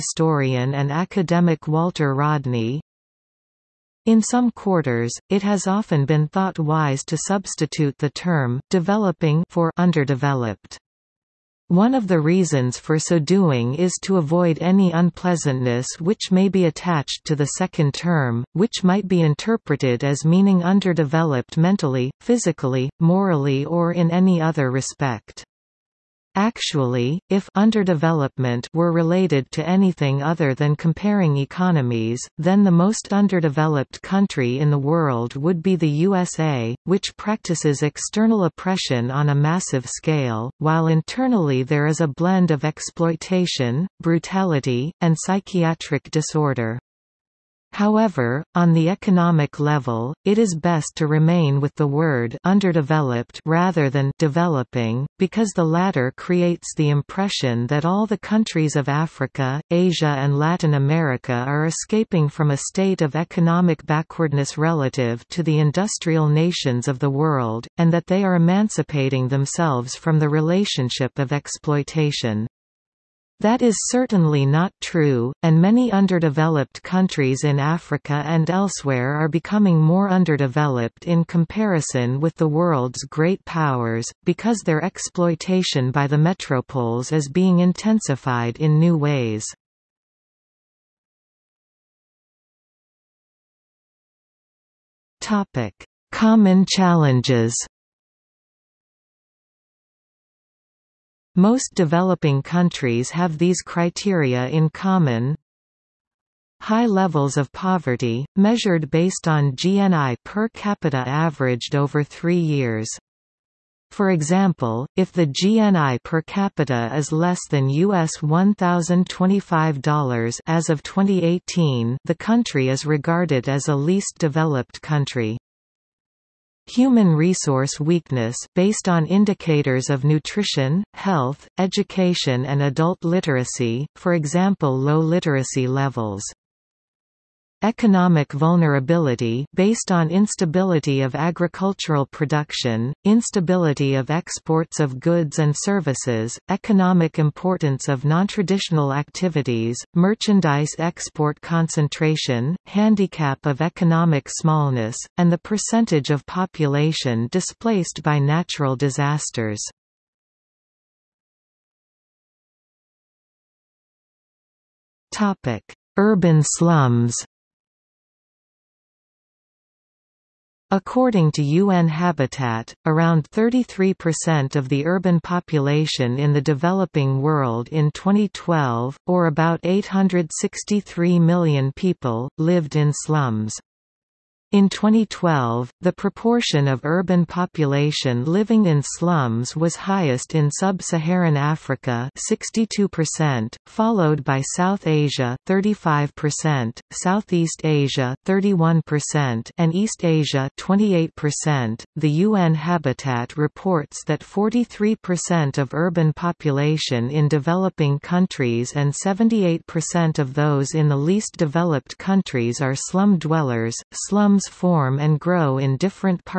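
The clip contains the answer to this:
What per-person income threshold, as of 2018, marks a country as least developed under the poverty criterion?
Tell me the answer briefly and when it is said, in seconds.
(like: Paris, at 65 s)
US $1,025, at 117 s.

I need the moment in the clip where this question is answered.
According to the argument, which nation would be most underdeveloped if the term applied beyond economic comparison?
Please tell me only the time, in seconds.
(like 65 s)
35 s.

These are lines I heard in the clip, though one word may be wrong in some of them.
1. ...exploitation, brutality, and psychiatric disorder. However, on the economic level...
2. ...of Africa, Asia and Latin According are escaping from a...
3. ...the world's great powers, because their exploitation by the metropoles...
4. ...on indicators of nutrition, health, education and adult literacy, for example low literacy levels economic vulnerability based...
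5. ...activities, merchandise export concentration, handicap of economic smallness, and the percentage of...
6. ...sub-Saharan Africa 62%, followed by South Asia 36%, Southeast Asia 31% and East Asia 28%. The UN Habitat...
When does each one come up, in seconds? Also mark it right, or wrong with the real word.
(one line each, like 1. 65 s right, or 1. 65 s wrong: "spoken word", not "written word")
1. 42 s right
2. 58 s wrong: "America", not "According"
3. 82 s right
4. 128 s right
5. 148 s right
6. 190 s wrong: "35", not "36".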